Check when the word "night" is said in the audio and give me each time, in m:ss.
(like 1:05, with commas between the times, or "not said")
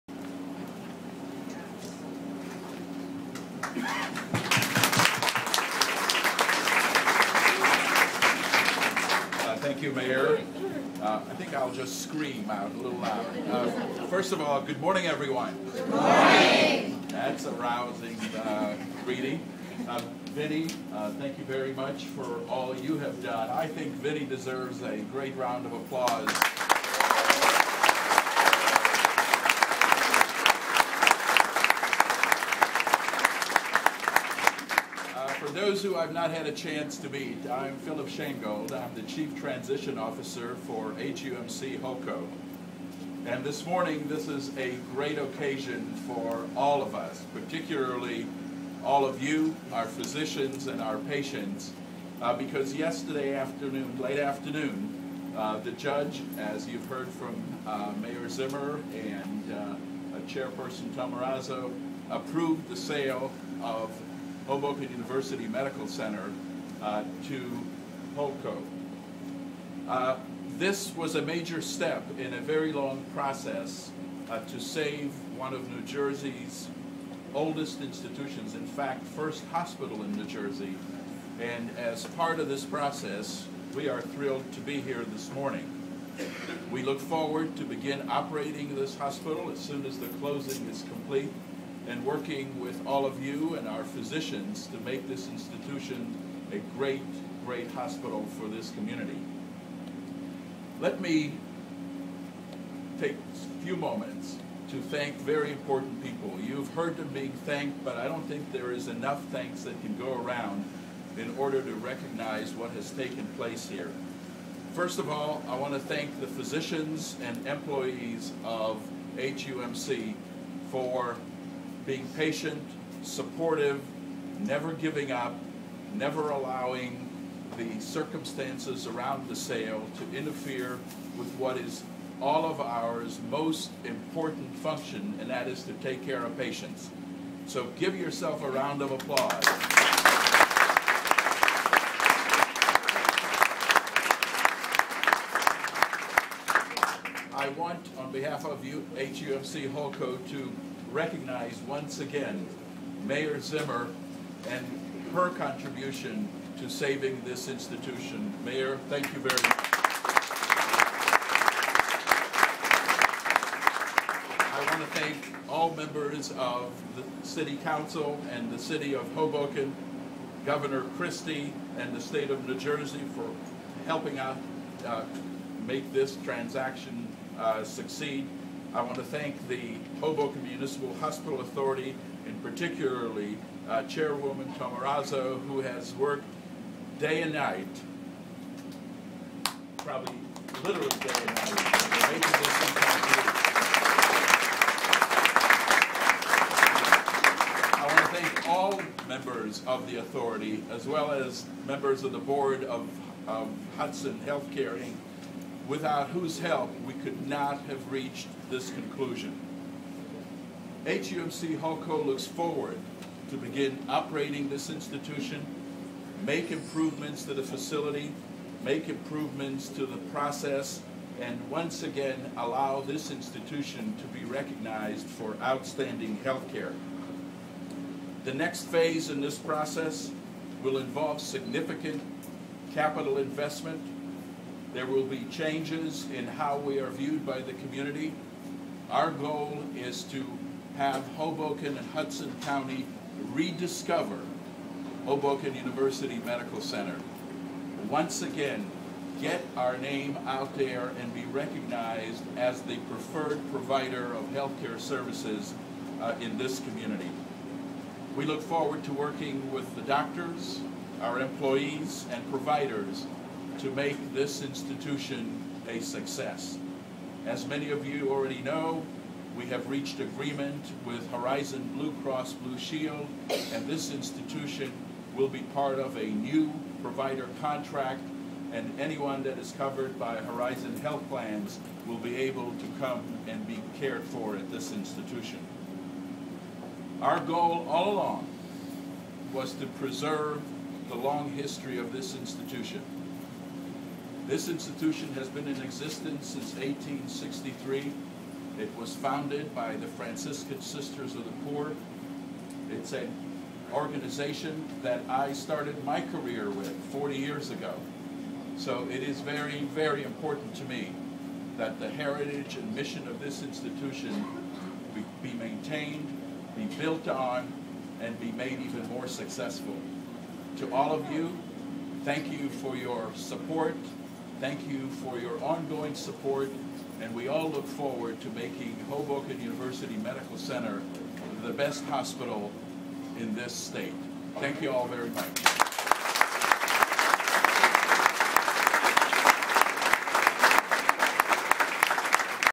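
3:07, 3:11.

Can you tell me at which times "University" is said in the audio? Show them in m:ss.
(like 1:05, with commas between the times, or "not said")
1:04, 4:05, 5:29.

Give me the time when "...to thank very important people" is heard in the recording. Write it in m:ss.
1:44.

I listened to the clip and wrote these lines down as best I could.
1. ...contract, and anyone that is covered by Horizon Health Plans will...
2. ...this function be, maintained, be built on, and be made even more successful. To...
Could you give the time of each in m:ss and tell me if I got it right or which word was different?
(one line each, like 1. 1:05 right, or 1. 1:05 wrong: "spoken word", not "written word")
1. 4:37 right
2. 5:13 wrong: "institution", not "function".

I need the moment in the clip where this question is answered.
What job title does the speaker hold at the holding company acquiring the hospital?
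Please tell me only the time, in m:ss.
0:39.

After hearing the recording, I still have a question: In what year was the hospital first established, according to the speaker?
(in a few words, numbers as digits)
1863.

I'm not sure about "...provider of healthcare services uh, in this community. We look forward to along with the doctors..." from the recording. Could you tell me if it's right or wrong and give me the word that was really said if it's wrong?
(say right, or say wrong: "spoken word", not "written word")
wrong: "working", not "along".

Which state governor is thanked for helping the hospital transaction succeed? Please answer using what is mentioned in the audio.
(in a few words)
Governor Christie.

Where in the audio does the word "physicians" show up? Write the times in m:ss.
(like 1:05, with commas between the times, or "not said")
0:49, 1:33, 1:56.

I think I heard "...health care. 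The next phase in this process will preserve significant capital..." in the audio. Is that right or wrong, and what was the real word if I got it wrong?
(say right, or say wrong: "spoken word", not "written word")
wrong: "involve", not "preserve".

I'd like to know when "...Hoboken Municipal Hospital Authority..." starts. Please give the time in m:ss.
2:59.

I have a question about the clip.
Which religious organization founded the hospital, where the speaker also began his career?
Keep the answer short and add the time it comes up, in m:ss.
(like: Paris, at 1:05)
Franciscan Sisters of the Poor, at 4:59.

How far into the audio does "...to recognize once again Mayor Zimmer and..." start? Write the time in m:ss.
2:30.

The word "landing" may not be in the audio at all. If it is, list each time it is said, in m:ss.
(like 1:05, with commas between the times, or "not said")
not said.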